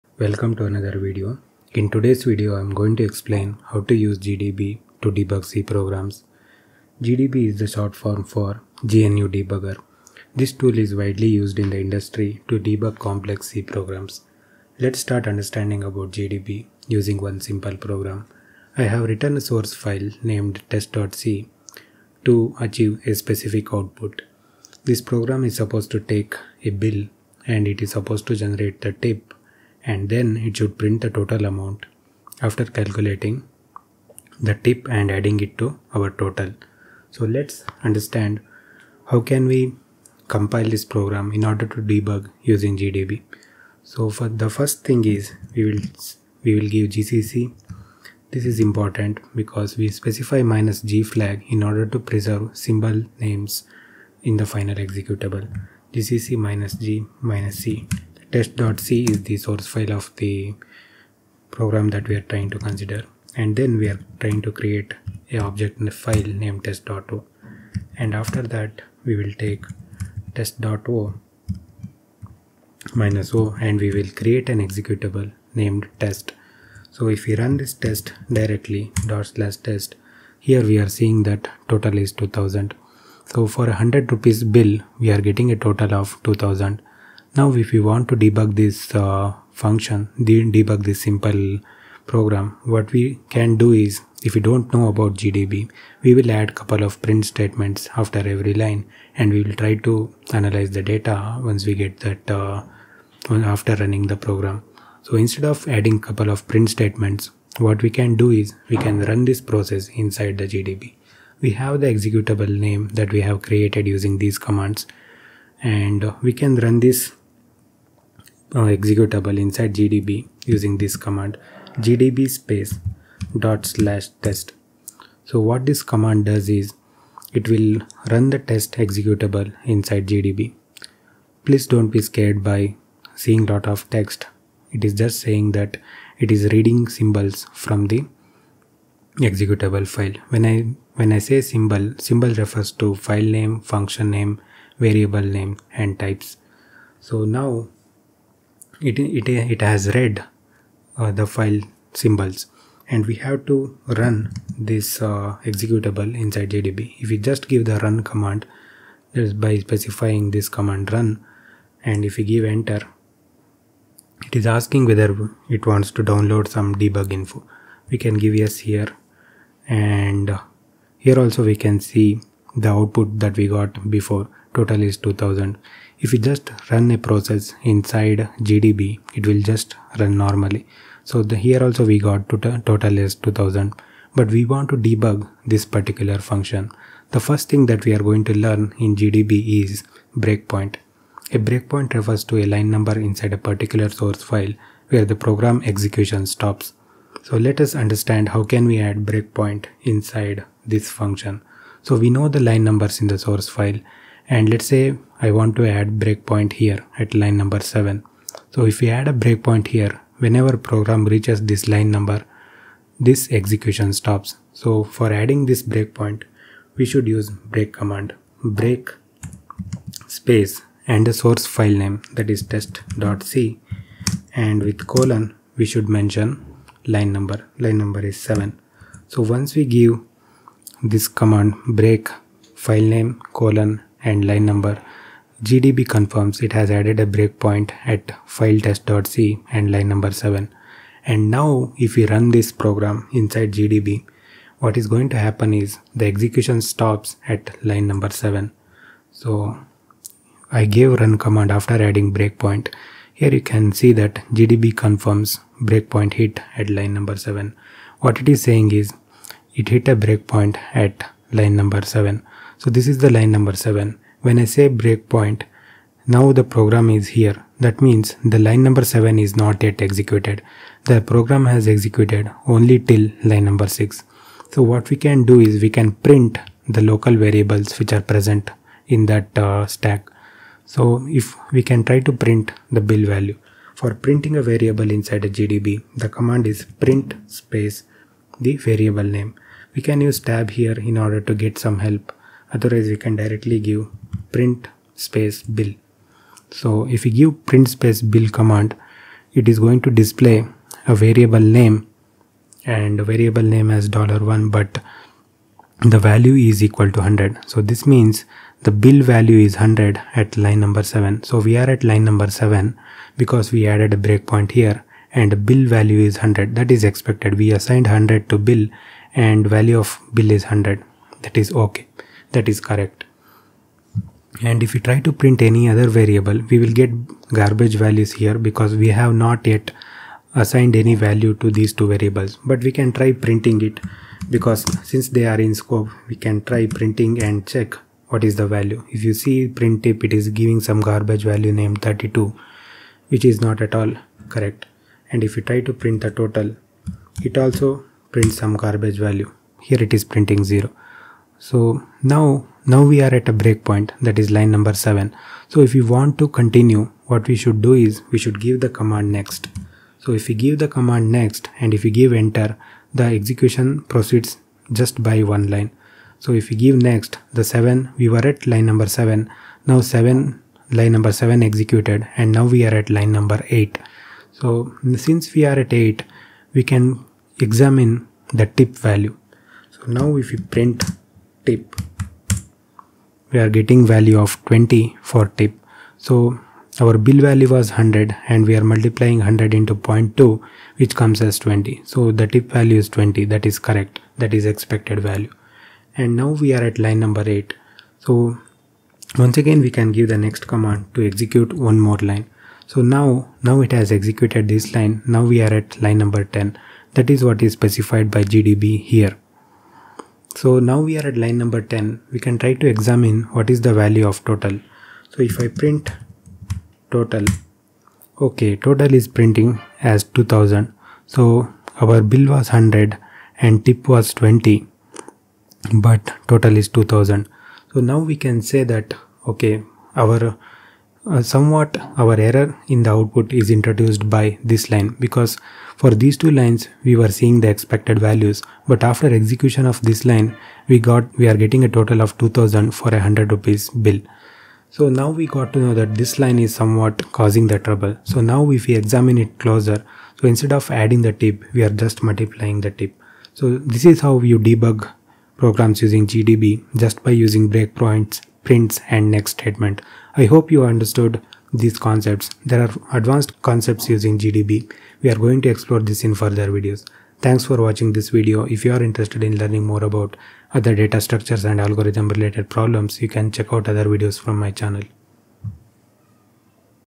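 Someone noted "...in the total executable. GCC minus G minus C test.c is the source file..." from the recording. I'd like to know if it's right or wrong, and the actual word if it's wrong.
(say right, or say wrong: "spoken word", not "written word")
wrong: "final", not "total".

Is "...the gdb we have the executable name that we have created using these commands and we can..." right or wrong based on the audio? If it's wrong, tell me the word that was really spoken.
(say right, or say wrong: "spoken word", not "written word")
right.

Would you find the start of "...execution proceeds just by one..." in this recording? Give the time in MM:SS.
06:03.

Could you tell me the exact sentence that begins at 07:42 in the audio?
There are advanced concepts using GDB.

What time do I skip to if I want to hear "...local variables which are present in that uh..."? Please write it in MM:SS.
04:36.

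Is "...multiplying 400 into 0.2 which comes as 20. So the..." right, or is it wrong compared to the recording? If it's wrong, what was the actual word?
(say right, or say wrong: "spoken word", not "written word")
wrong: "100", not "400".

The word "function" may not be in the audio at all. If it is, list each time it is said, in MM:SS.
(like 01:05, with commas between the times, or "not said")
01:29, 02:23, 03:06, 03:20.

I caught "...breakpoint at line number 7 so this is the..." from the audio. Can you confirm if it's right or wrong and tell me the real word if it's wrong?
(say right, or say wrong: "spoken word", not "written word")
right.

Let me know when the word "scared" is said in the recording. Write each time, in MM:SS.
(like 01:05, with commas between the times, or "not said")
02:12.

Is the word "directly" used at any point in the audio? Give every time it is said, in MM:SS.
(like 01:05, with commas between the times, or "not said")
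01:18, 04:53.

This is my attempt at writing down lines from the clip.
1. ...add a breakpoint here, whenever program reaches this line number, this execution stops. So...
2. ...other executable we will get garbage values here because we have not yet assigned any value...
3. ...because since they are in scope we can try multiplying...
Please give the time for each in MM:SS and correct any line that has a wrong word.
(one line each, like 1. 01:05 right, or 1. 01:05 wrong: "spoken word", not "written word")
1. 03:28 right
2. 05:25 wrong: "variable", not "executable"
3. 05:34 wrong: "printing", not "multiplying".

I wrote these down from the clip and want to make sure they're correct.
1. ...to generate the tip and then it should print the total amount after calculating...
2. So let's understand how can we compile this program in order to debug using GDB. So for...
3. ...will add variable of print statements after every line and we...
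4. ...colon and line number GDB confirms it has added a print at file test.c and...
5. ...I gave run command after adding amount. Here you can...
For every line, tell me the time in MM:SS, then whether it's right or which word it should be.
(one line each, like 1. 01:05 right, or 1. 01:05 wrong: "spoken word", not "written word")
1. 00:28 right
2. 00:37 right
3. 01:36 wrong: "couple", not "variable"
4. 03:53 wrong: "breakpoint", not "print"
5. 04:10 wrong: "breakpoint", not "amount".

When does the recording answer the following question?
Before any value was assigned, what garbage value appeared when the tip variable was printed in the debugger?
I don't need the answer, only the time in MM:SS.
05:41.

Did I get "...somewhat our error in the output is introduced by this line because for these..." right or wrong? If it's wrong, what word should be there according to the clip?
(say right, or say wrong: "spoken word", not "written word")
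right.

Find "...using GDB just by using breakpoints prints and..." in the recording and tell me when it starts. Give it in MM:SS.
07:35.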